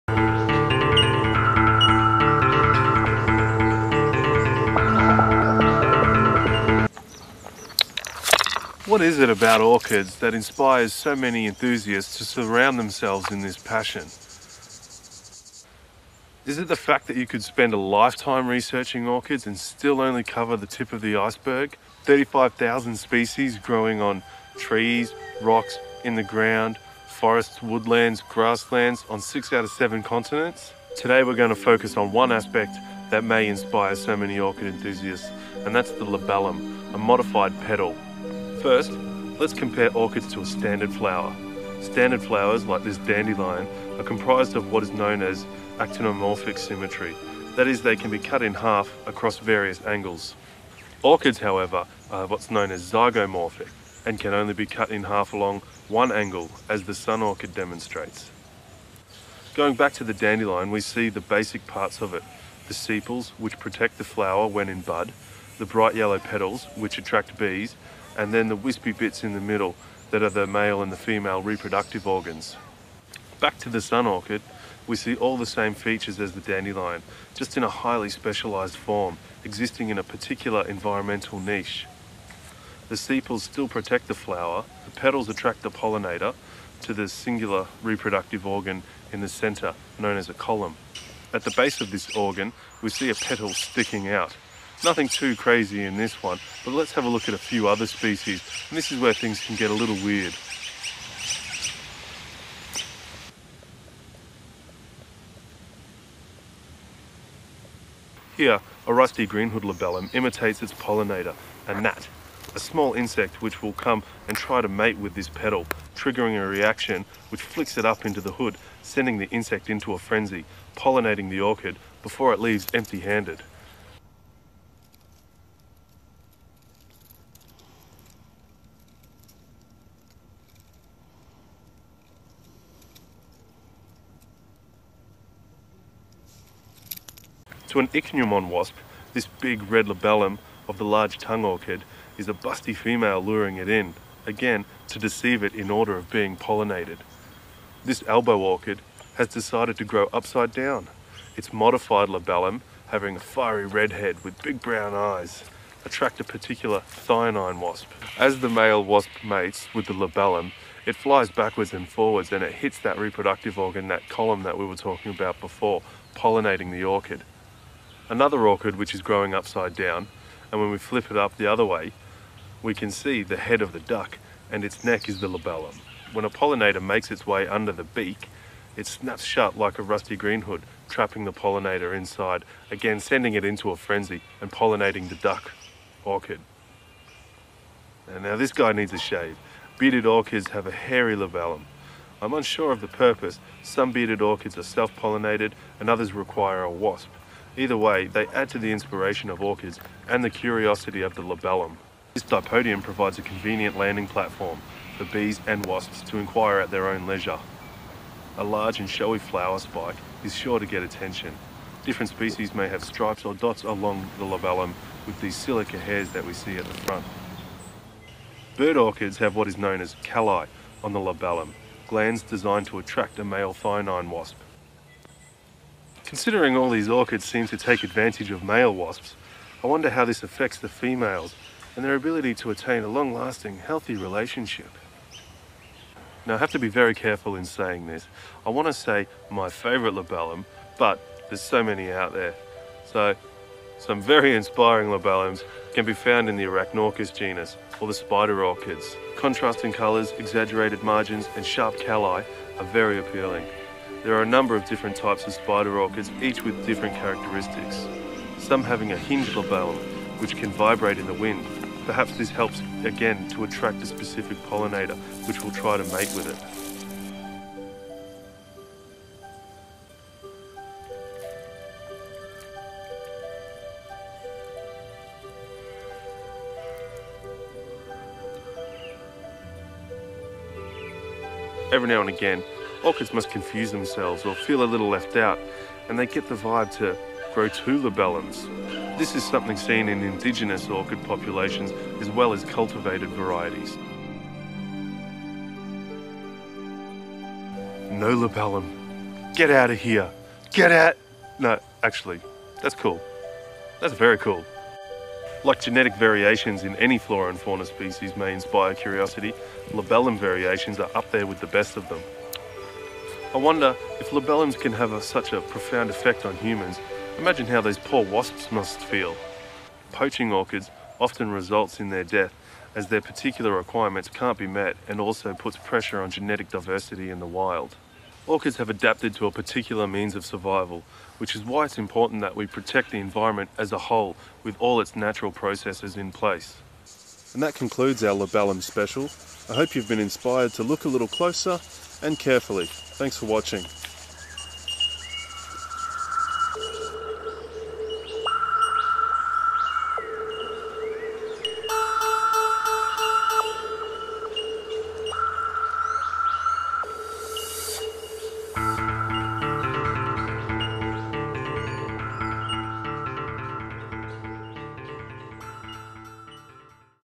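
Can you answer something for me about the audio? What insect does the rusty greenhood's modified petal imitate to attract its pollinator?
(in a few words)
a gnat.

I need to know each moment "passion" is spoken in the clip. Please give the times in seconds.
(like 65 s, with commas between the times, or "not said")
13 s.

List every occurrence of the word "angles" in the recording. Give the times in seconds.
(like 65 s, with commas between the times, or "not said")
49 s, 56 s.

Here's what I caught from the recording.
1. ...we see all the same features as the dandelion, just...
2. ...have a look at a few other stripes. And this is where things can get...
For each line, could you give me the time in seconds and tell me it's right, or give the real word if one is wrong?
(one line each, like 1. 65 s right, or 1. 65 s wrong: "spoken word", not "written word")
1. 74 s right
2. 96 s wrong: "species", not "stripes".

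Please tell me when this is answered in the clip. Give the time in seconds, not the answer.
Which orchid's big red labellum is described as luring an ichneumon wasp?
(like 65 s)
140 s.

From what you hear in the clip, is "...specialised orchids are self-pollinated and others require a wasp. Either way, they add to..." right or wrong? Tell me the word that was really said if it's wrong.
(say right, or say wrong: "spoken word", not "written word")
wrong: "bearded", not "specialised".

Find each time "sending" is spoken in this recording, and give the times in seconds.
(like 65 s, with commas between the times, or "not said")
118 s, 182 s.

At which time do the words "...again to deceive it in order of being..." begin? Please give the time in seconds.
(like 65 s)
144 s.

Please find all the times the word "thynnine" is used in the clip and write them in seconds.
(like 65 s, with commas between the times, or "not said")
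156 s, 223 s.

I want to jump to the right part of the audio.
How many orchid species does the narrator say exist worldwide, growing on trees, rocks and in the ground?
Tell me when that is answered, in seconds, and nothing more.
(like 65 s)
22 s.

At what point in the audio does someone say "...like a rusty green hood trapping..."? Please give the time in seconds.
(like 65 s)
179 s.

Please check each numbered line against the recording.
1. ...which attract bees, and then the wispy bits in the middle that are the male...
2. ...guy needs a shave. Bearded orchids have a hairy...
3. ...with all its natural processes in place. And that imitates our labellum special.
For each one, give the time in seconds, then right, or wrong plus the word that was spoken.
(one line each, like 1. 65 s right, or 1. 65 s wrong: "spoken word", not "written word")
1. 66 s right
2. 188 s right
3. 334 s wrong: "concludes", not "imitates".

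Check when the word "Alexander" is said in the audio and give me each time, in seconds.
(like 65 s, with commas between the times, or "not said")
not said.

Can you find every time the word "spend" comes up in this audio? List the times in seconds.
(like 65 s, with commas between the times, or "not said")
17 s.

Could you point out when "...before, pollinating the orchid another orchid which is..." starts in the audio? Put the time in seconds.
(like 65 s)
165 s.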